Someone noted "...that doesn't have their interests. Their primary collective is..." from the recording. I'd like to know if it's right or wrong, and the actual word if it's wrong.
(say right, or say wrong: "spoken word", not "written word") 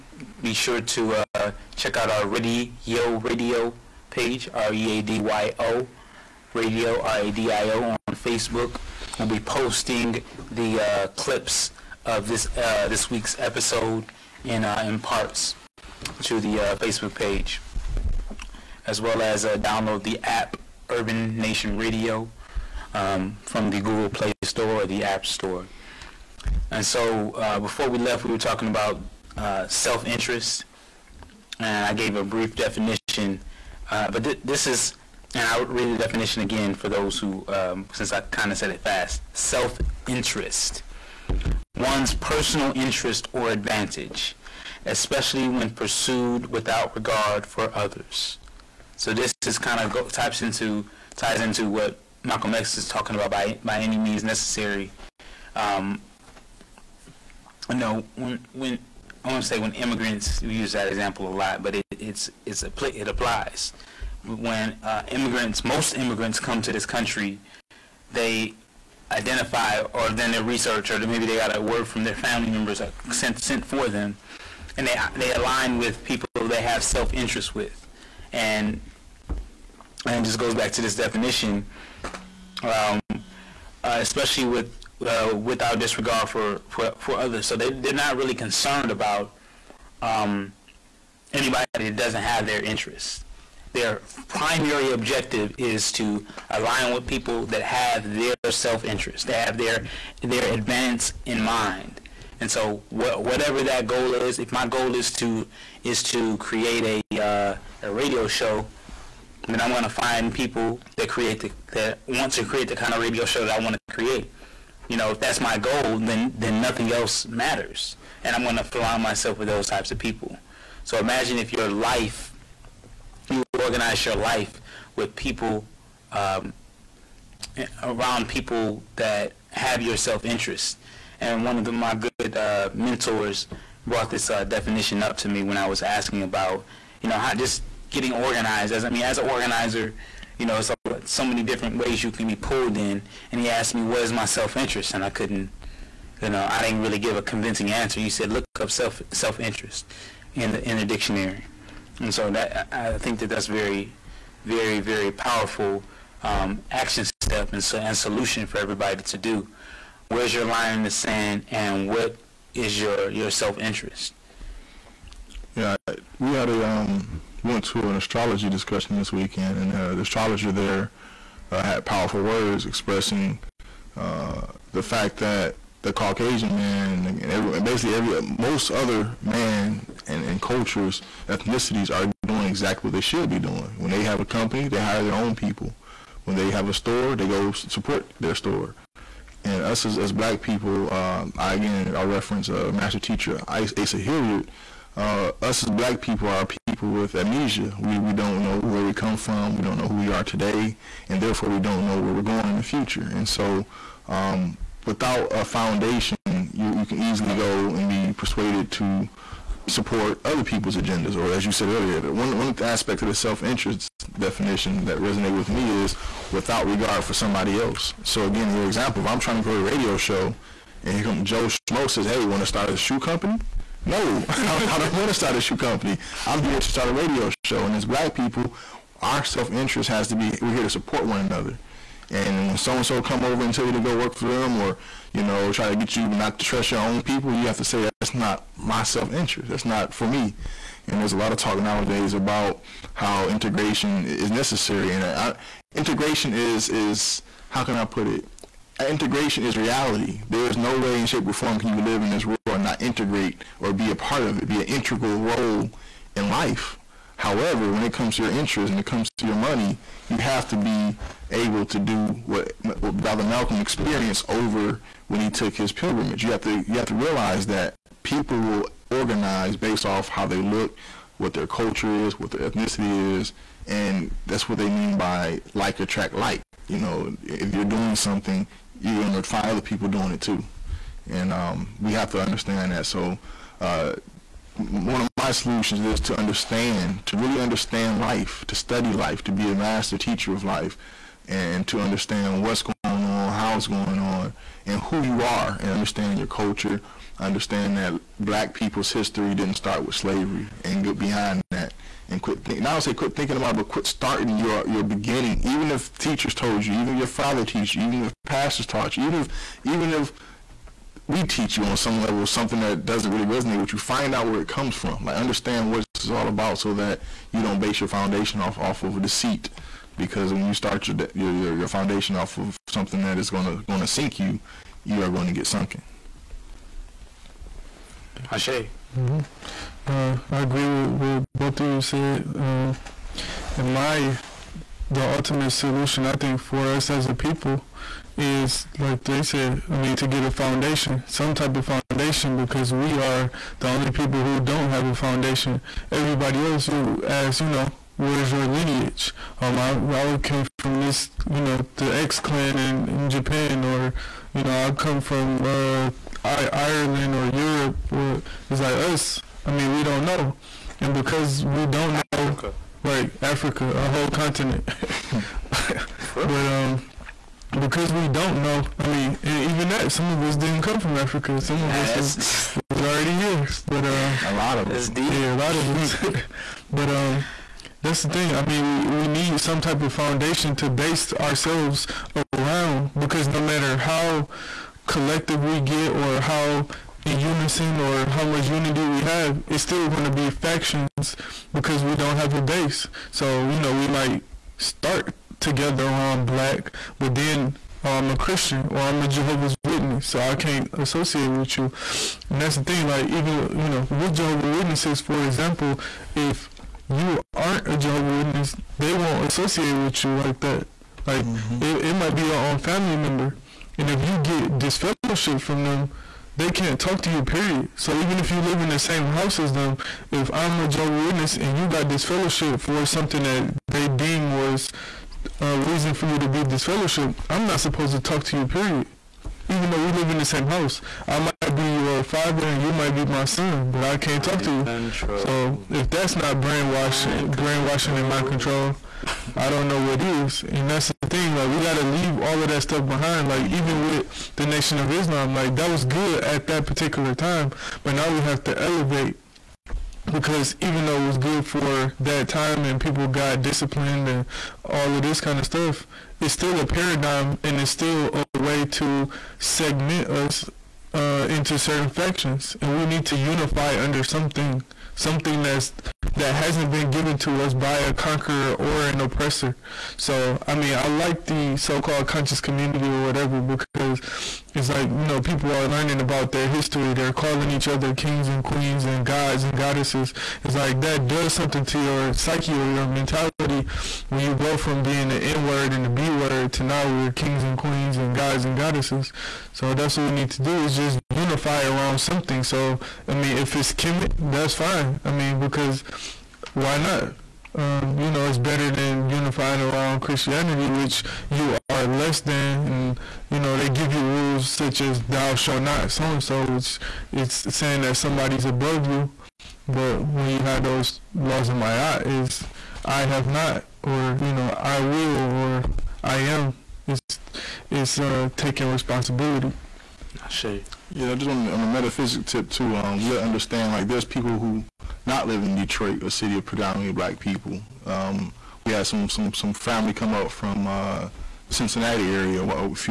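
wrong: "objective", not "collective".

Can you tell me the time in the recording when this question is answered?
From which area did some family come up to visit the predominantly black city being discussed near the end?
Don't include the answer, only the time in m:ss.
8:51.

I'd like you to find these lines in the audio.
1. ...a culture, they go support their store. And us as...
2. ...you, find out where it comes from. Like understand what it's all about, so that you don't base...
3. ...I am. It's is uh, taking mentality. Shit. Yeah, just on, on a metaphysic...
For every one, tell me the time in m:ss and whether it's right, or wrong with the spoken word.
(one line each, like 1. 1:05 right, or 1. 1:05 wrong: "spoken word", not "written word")
1. 3:06 wrong: "store", not "culture"
2. 5:13 right
3. 8:36 wrong: "responsibility", not "mentality".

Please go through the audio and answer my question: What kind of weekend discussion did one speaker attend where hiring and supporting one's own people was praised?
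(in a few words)
astrology discussion.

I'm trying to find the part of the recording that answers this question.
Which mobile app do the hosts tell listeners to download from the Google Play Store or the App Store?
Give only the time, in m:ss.
0:20.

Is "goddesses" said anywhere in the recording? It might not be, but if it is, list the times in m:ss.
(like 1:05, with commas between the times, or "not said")
7:59, 8:08.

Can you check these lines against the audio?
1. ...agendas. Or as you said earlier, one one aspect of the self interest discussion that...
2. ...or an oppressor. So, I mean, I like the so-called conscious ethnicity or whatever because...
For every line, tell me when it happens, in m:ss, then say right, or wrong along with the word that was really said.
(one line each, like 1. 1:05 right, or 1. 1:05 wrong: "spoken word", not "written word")
1. 3:30 wrong: "definition", not "discussion"
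2. 7:48 wrong: "community", not "ethnicity".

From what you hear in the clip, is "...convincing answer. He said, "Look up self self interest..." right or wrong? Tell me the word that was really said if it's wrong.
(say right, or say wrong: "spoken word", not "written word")
right.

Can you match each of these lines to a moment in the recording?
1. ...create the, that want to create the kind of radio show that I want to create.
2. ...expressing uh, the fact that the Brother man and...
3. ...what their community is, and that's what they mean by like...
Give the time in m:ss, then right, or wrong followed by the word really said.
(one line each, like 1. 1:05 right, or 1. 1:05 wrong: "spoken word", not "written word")
1. 1:51 right
2. 2:52 wrong: "Caucasian", not "Brother"
3. 4:32 wrong: "ethnicity", not "community".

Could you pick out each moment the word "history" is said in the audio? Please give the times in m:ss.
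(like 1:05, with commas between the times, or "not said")
4:58, 7:56.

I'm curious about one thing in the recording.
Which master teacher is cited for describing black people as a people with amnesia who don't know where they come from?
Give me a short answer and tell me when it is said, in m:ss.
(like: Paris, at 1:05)
Asa Hilliard, at 3:13.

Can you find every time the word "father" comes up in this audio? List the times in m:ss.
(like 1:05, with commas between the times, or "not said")
5:07, 7:12.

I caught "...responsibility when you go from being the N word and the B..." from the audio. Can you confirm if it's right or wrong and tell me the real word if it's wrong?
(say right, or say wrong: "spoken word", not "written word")
wrong: "mentality", not "responsibility".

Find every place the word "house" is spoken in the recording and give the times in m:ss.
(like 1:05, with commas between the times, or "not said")
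6:59, 7:10.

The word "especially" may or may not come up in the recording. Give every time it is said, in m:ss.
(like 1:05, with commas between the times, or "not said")
0:44, 1:23.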